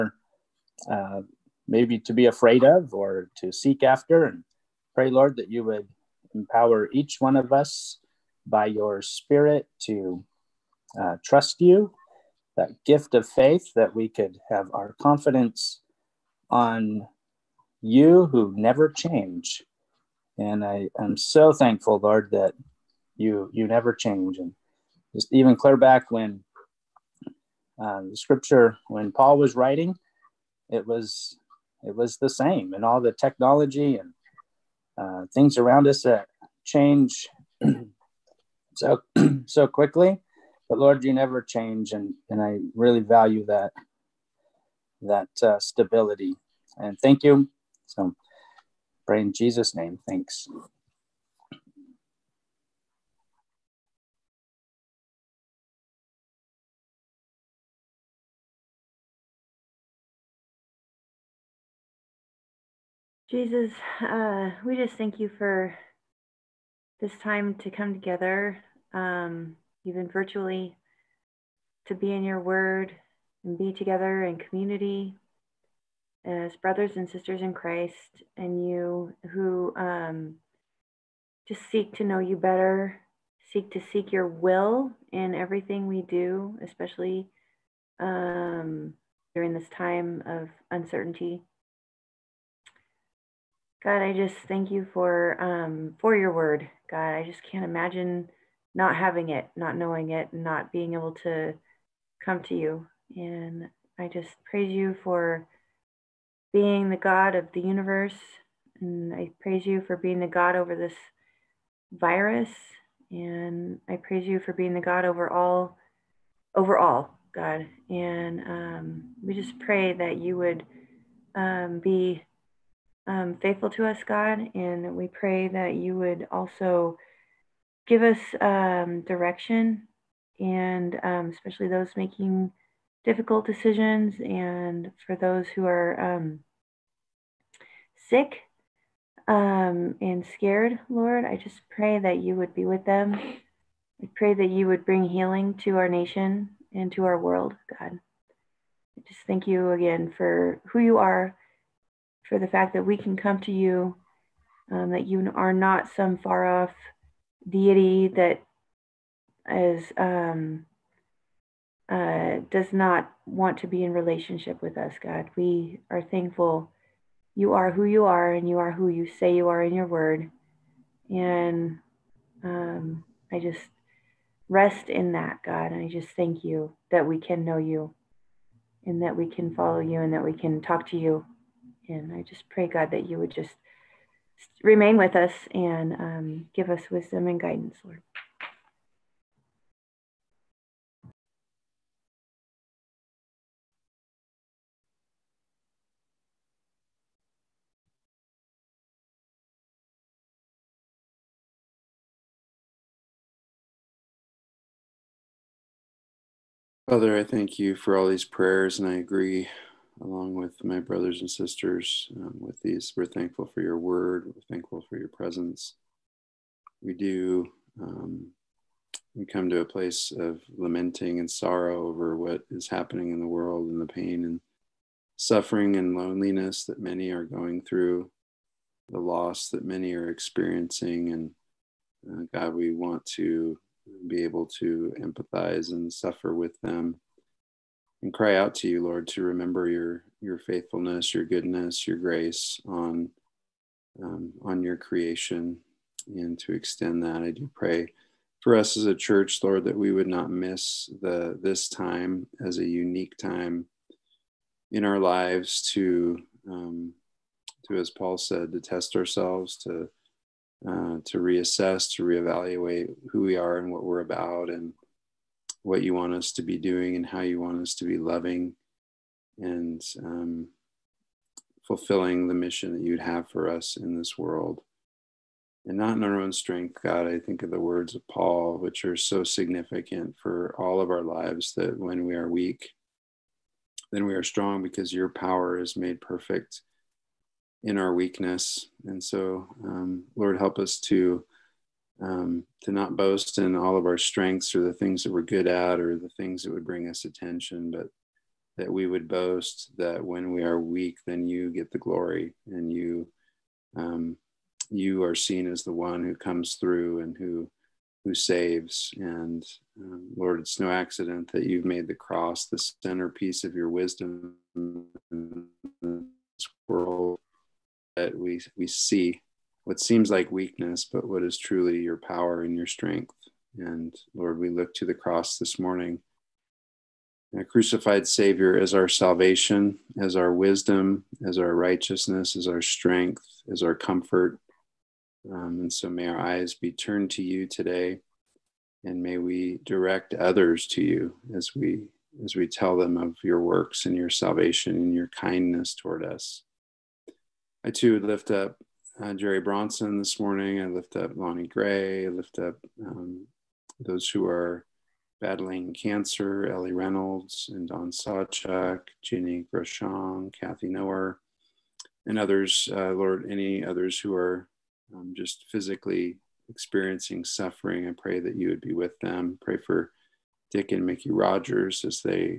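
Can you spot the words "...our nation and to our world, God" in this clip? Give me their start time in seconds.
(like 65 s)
145 s.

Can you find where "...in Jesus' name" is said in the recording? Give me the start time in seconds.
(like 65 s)
49 s.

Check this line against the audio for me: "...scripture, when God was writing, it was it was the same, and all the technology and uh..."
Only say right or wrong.
wrong.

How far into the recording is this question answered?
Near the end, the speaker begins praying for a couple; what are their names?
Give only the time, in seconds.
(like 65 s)
370 s.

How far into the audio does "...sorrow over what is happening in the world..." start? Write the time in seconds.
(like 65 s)
221 s.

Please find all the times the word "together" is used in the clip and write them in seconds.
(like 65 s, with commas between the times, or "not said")
67 s, 73 s.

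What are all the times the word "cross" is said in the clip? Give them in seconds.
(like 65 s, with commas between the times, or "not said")
311 s, 324 s.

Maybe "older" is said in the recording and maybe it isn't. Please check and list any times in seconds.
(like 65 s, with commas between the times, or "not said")
not said.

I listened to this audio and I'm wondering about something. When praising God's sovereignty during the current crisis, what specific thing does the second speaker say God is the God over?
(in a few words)
this virus.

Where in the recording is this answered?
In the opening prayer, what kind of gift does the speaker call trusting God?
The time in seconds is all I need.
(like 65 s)
13 s.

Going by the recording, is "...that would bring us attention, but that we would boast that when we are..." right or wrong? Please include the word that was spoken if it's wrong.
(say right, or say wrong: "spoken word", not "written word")
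right.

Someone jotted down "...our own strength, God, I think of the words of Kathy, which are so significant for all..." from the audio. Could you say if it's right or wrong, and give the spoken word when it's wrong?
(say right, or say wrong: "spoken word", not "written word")
wrong: "Paul", not "Kathy".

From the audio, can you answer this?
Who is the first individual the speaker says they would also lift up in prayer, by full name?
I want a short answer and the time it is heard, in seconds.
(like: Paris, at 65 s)
Jerry Bronson, at 349 s.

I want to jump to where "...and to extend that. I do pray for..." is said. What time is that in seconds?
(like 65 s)
246 s.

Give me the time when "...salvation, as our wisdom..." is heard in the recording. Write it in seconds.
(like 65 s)
328 s.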